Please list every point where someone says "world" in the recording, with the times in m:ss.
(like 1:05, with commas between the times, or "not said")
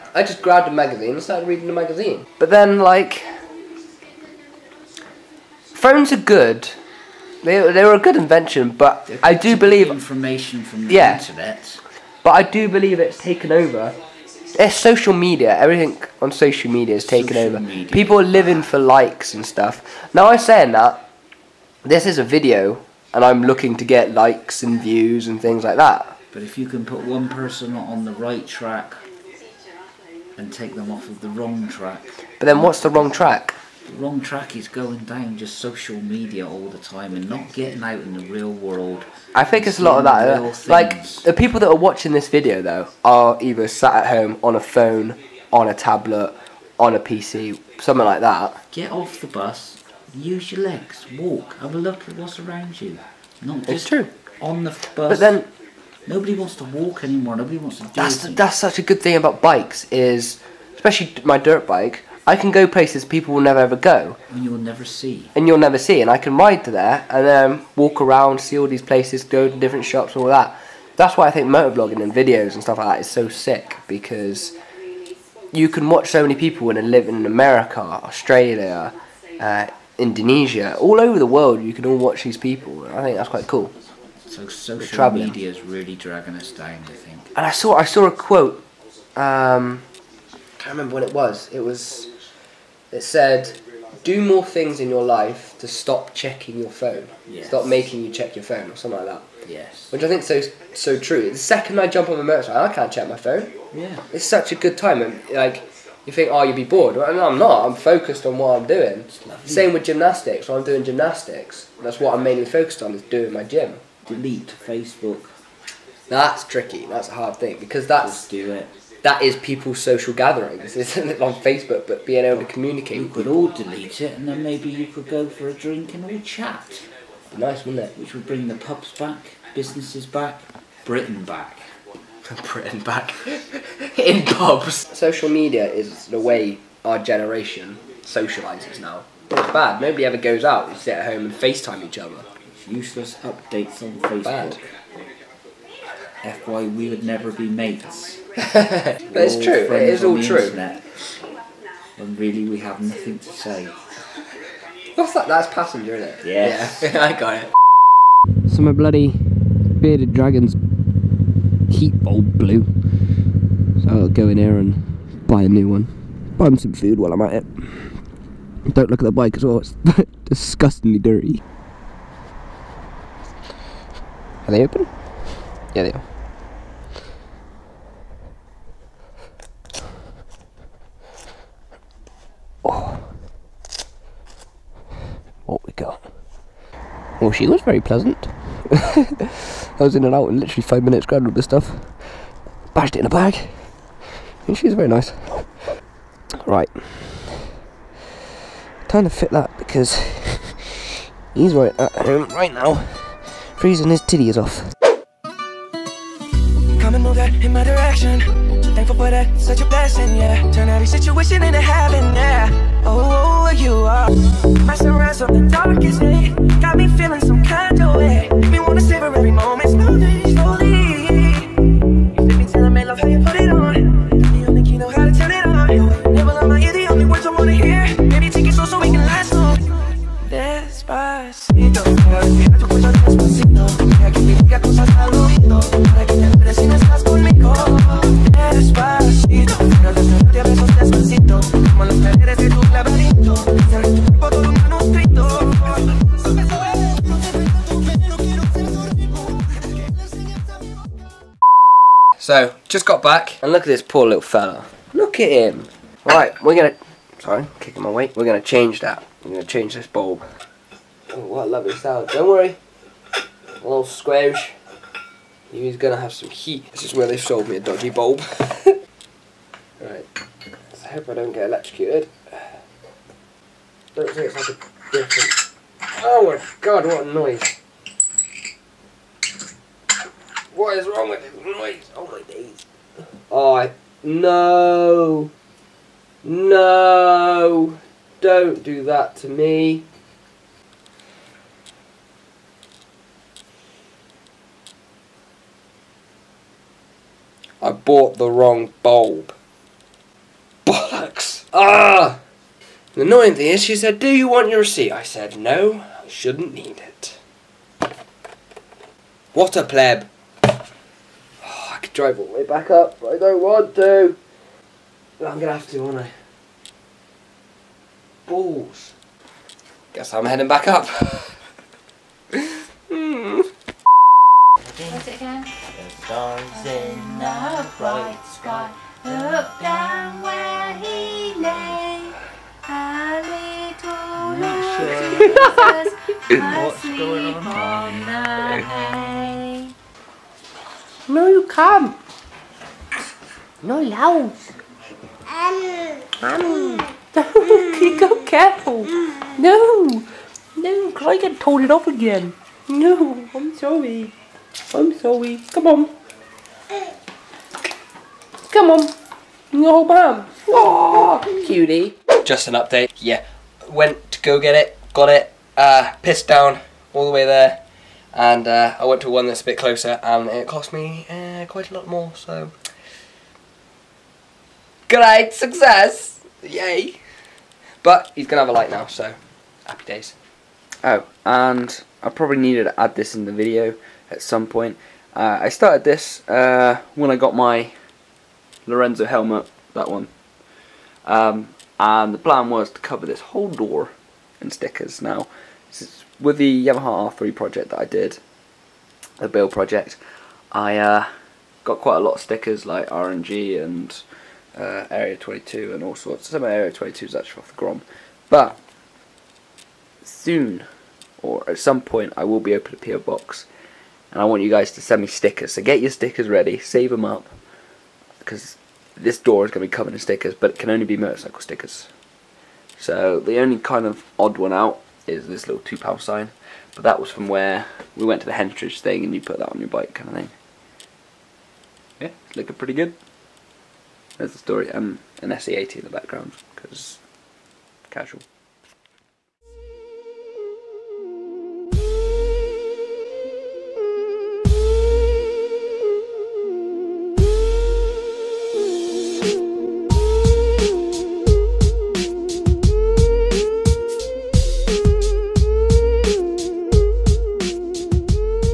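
0:38, 1:21.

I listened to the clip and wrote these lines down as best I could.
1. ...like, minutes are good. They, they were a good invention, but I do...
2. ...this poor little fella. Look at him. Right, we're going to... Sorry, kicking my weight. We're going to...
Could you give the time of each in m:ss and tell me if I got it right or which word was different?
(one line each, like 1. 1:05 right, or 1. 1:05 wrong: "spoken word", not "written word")
1. 0:02 wrong: "phones", not "minutes"
2. 4:13 right.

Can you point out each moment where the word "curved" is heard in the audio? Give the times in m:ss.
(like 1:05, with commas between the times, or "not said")
not said.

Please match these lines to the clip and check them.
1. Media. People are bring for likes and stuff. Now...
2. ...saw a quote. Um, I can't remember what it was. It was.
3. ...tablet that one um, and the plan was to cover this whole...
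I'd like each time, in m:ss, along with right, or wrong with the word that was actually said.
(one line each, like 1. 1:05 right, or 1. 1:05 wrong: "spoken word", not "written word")
1. 0:17 wrong: "living", not "bring"
2. 1:27 right
3. 6:29 wrong: "helmet", not "tablet".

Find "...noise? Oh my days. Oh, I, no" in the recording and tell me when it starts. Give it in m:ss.
4:41.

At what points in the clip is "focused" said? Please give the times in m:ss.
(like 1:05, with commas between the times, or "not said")
1:47, 1:52.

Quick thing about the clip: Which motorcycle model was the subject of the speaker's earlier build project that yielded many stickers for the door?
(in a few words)
Yamaha R3.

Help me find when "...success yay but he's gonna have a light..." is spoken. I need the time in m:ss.
6:15.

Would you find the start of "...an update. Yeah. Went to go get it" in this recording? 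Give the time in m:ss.
6:02.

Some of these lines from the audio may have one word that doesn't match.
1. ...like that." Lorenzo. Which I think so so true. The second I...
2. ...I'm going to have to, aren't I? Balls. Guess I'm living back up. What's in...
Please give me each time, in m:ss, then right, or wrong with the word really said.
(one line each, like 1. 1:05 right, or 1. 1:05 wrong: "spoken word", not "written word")
1. 1:39 wrong: "Yes", not "Lorenzo"
2. 5:15 wrong: "heading", not "living".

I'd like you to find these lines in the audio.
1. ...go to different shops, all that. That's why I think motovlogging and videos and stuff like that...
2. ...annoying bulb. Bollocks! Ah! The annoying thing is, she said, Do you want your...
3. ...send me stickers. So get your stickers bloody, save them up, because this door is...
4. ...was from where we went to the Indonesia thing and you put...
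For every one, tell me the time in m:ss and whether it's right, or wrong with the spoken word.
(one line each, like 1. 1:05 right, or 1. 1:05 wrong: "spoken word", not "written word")
1. 1:09 right
2. 4:58 wrong: "wrong", not "annoying"
3. 6:54 wrong: "ready", not "bloody"
4. 7:06 wrong: "Henstridge", not "Indonesia".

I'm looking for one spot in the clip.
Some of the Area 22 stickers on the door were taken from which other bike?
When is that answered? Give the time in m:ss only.
6:47.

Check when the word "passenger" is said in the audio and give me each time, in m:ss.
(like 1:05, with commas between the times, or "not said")
2:35.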